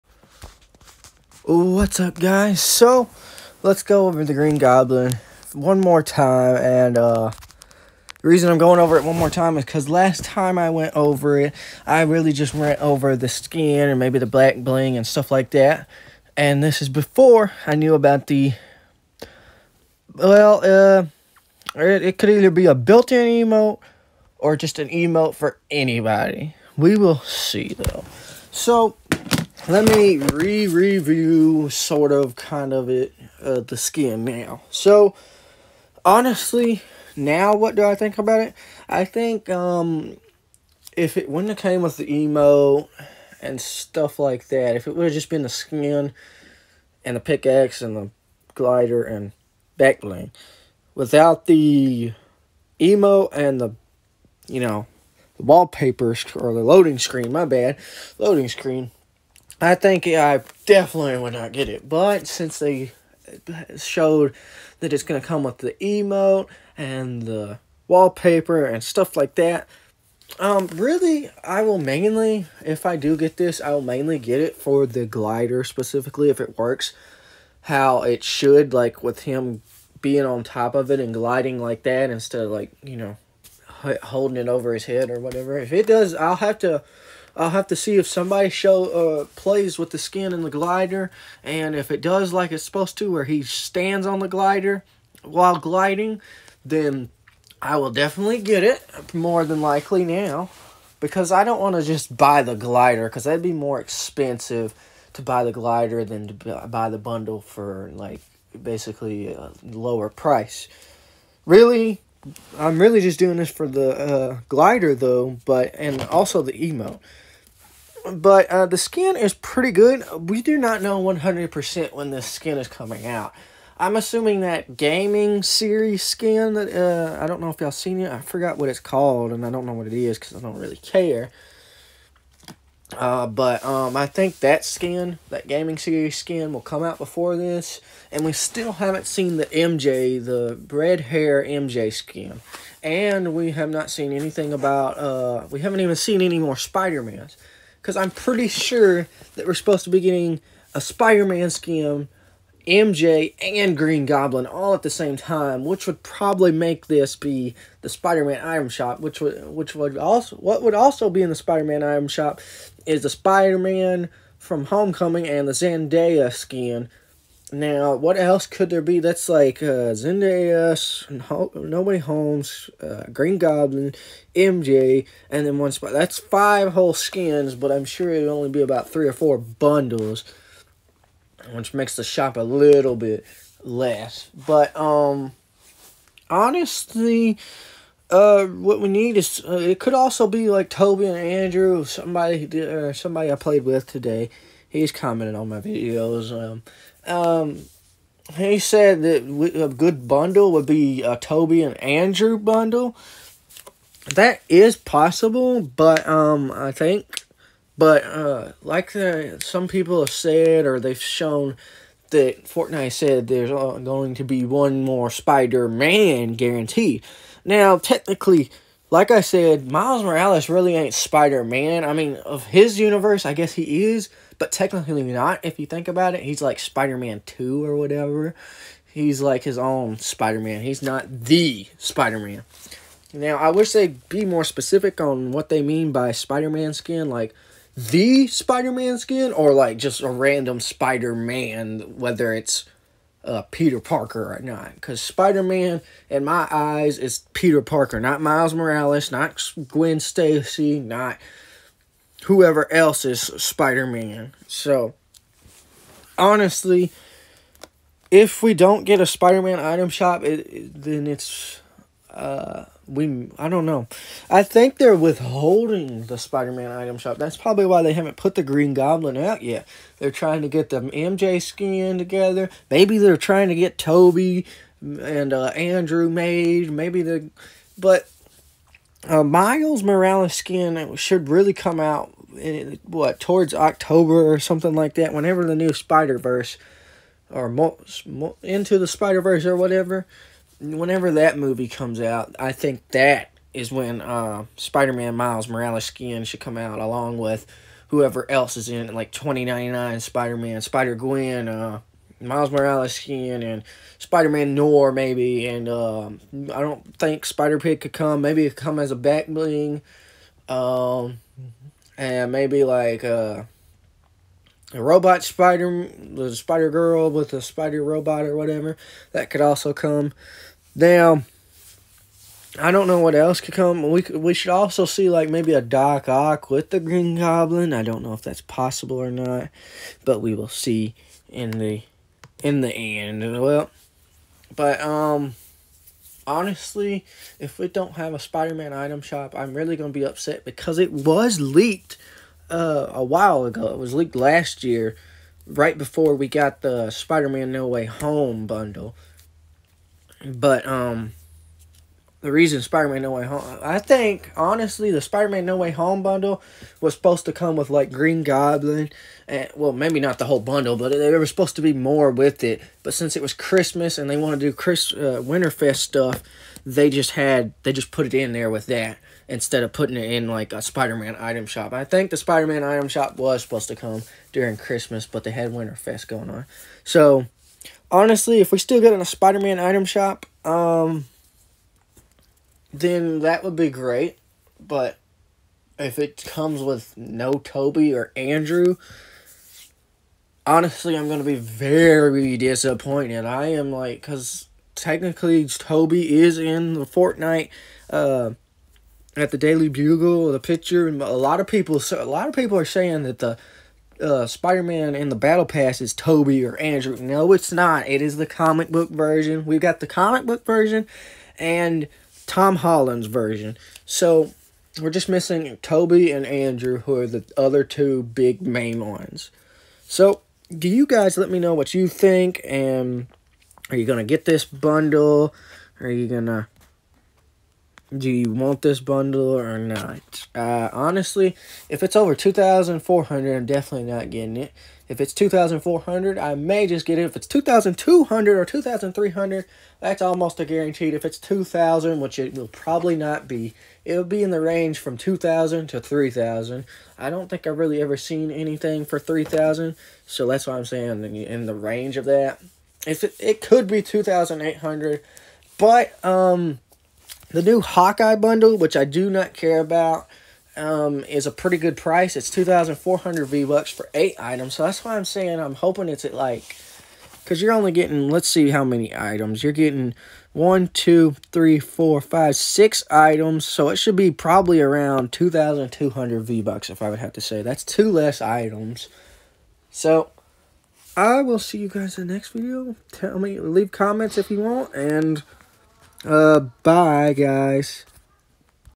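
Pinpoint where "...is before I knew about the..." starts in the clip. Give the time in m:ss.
0:16.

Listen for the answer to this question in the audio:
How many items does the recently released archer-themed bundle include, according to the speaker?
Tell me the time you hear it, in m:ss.
7:43.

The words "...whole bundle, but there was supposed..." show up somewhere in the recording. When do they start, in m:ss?
6:00.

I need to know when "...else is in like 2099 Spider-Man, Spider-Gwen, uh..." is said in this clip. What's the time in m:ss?
4:58.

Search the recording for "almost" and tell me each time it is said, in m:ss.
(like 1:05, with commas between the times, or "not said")
7:20.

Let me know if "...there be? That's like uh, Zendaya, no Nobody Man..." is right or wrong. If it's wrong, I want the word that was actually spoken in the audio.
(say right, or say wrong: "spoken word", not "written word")
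wrong: "Holmes", not "Man".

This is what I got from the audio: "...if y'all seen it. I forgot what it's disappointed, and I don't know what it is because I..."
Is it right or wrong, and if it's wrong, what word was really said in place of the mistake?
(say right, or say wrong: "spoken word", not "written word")
wrong: "called", not "disappointed".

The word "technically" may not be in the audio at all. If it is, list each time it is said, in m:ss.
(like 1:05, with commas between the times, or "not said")
3:37, 3:44, 6:34.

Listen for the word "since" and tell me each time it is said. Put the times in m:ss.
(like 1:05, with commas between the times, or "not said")
1:02, 6:02.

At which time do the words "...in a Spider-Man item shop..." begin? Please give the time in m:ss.
6:18.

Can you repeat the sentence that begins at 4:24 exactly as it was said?
I think they're withholding the Spider-Man item shop.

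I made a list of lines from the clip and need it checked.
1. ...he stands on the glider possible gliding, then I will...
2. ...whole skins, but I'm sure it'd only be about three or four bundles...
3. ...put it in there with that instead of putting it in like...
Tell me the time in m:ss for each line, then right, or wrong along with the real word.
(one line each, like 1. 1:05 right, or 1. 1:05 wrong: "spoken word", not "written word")
1. 1:33 wrong: "while", not "possible"
2. 2:56 right
3. 6:07 right.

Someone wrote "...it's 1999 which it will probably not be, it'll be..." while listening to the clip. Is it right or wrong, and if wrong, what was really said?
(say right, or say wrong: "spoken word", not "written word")
wrong: "2000", not "1999".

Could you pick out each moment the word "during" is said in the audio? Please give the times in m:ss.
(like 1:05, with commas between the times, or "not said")
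6:14.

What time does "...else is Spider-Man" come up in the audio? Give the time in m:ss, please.
4:12.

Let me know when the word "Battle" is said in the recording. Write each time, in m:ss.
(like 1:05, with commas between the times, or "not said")
6:45.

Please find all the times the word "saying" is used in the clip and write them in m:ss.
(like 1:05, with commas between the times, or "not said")
6:42, 7:30, 7:45.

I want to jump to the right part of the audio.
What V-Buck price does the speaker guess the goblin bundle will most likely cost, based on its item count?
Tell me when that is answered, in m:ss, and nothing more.
7:55.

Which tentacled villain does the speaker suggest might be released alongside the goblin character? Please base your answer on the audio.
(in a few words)
Doc Ock.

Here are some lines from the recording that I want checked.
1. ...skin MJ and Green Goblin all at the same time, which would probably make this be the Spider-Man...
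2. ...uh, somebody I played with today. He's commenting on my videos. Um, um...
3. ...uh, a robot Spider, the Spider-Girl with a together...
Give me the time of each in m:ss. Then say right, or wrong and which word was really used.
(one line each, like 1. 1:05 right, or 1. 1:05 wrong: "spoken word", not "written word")
1. 2:31 right
2. 3:12 right
3. 5:13 wrong: "spider", not "together".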